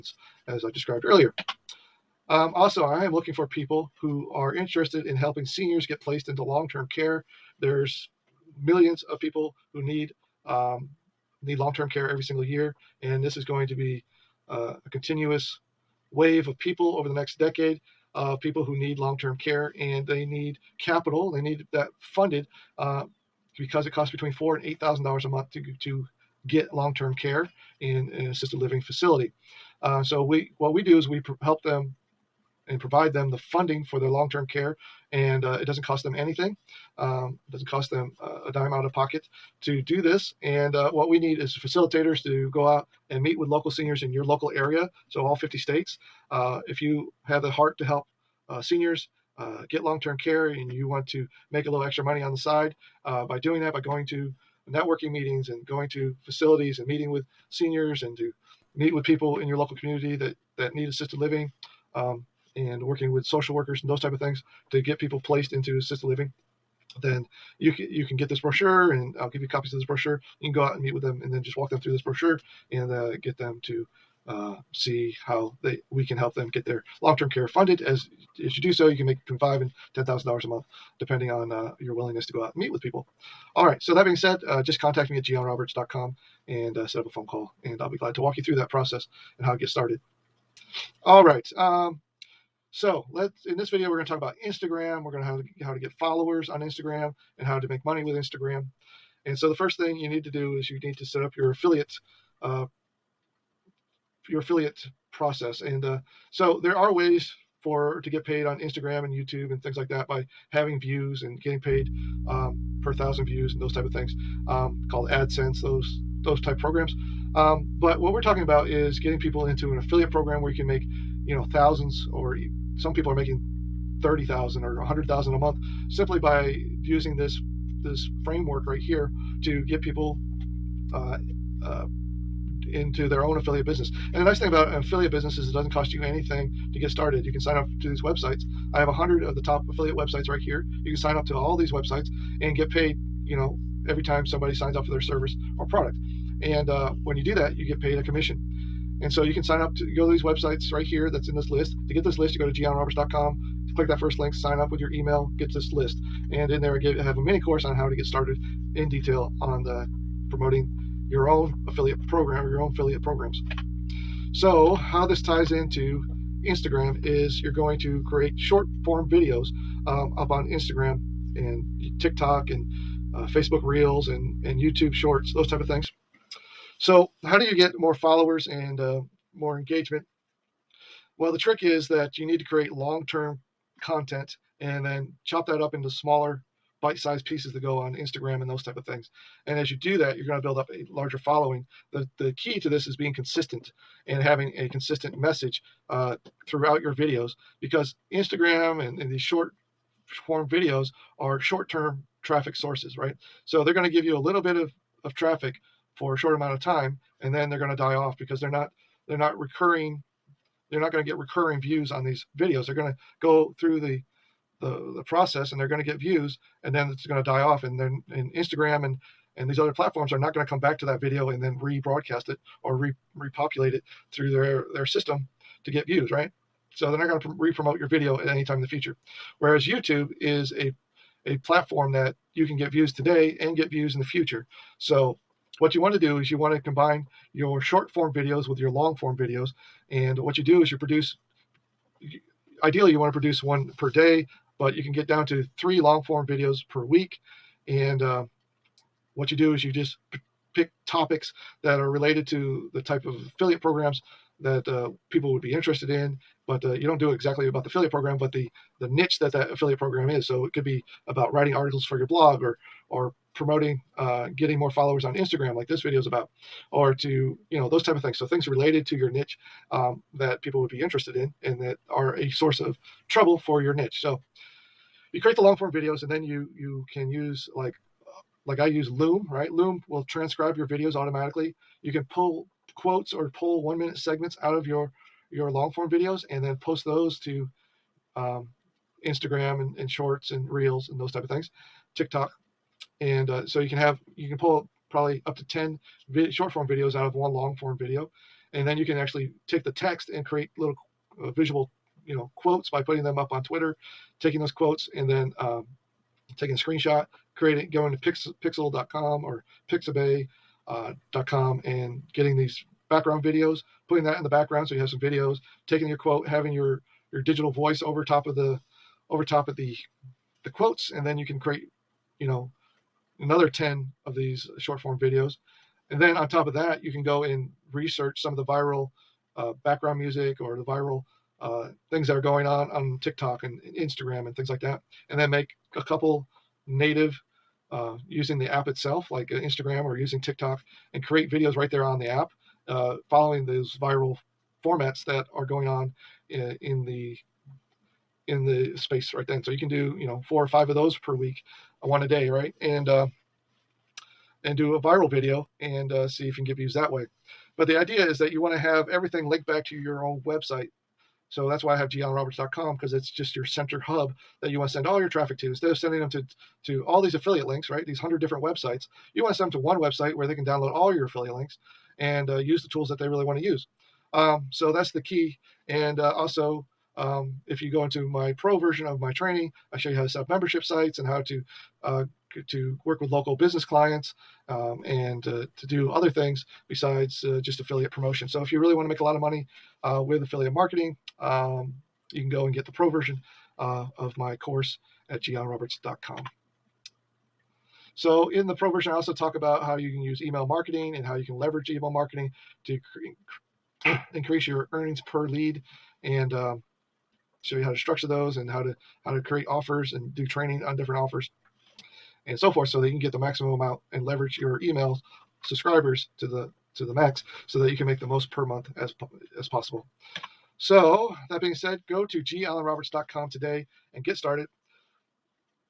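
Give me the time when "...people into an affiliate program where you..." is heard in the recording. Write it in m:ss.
1:59.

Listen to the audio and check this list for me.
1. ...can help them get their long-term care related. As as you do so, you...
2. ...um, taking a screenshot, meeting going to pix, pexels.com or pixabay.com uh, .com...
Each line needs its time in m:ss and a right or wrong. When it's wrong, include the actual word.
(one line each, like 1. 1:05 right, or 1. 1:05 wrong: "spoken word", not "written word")
1. 1:16 wrong: "funded", not "related"
2. 5:05 wrong: "creating", not "meeting".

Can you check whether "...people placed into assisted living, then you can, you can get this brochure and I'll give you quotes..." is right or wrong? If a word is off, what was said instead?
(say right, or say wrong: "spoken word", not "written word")
wrong: "copies", not "quotes".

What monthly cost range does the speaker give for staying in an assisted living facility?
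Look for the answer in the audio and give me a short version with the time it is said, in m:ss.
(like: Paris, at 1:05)
$4,000 to $8,000, at 0:24.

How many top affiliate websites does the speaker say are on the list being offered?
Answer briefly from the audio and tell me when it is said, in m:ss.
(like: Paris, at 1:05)
100, at 2:18.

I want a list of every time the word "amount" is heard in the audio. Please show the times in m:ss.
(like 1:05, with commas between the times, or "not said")
3:26, 6:53.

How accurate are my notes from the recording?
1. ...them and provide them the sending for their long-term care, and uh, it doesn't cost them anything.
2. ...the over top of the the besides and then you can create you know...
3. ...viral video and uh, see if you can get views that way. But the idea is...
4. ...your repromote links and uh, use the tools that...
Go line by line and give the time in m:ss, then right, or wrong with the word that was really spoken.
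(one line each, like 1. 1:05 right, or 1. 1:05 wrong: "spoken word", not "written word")
1. 0:31 wrong: "funding", not "sending"
2. 5:18 wrong: "quotes", not "besides"
3. 5:54 right
4. 6:10 wrong: "affiliate", not "repromote".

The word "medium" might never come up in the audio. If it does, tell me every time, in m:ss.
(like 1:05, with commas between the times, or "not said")
not said.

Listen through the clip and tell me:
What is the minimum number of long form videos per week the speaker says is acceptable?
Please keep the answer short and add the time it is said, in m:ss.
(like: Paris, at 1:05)
3, at 4:05.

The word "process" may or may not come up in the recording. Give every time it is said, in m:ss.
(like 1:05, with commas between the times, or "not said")
1:28, 1:45, 3:35.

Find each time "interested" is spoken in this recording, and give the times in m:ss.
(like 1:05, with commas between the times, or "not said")
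0:04, 4:15, 4:30.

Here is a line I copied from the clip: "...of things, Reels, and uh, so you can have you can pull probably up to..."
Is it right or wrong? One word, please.
wrong.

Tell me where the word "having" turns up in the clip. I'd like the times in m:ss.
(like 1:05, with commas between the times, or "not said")
1:50, 3:14, 5:16.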